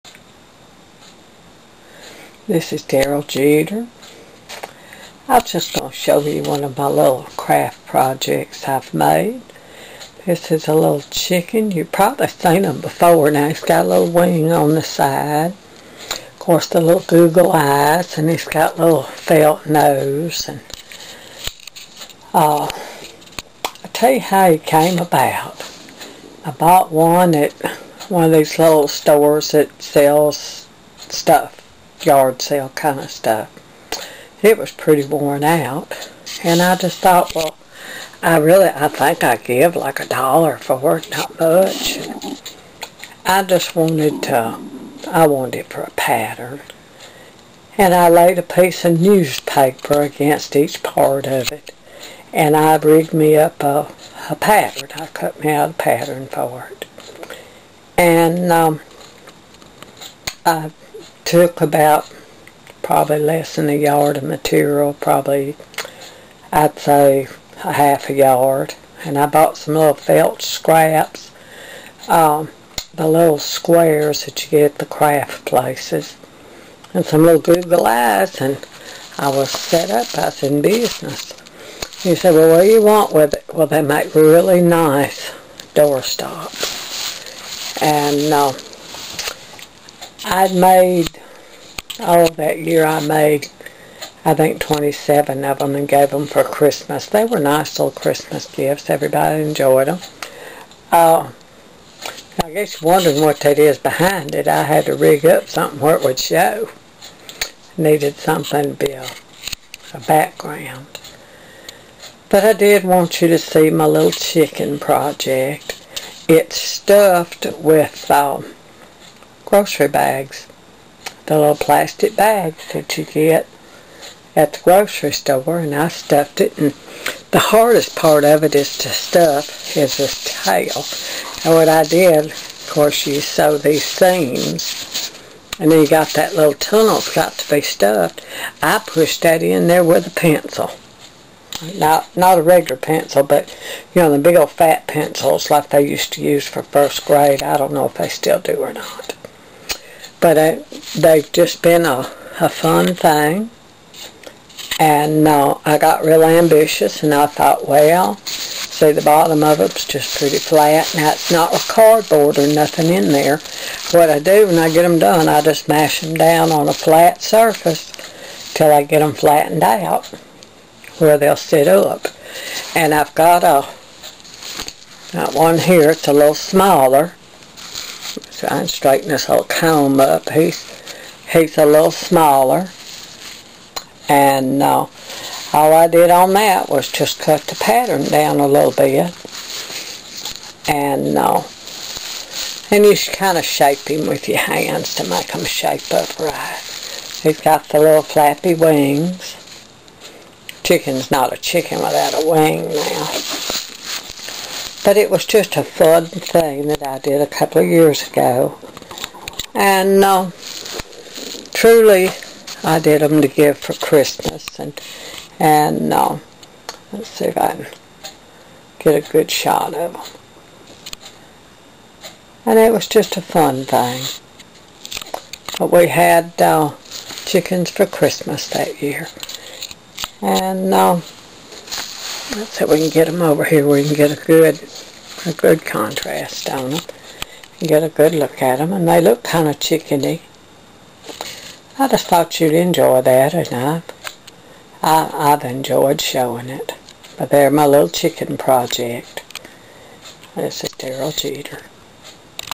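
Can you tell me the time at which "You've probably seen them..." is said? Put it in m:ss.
0:11.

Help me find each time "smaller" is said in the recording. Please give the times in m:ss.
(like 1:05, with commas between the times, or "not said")
2:56, 3:01.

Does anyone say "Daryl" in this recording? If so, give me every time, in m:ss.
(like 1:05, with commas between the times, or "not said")
0:02, 4:10.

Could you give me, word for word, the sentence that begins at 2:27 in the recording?
I don't know if they still do or not.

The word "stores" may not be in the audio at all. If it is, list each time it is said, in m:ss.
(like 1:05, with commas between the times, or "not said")
0:28, 2:05.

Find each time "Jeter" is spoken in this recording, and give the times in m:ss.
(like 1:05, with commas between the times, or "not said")
0:03, 4:11.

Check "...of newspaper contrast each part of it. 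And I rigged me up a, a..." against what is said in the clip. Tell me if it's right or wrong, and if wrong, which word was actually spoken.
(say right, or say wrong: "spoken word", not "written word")
wrong: "against", not "contrast".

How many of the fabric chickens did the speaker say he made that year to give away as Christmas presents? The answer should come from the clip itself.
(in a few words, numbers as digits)
27.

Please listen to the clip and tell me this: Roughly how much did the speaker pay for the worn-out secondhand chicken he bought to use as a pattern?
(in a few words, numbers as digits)
a dollar.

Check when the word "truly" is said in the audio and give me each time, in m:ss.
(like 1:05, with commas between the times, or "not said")
3:31.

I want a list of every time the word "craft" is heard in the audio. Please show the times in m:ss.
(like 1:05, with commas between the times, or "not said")
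0:07, 1:14.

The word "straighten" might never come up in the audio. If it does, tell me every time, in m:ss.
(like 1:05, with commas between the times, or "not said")
2:58.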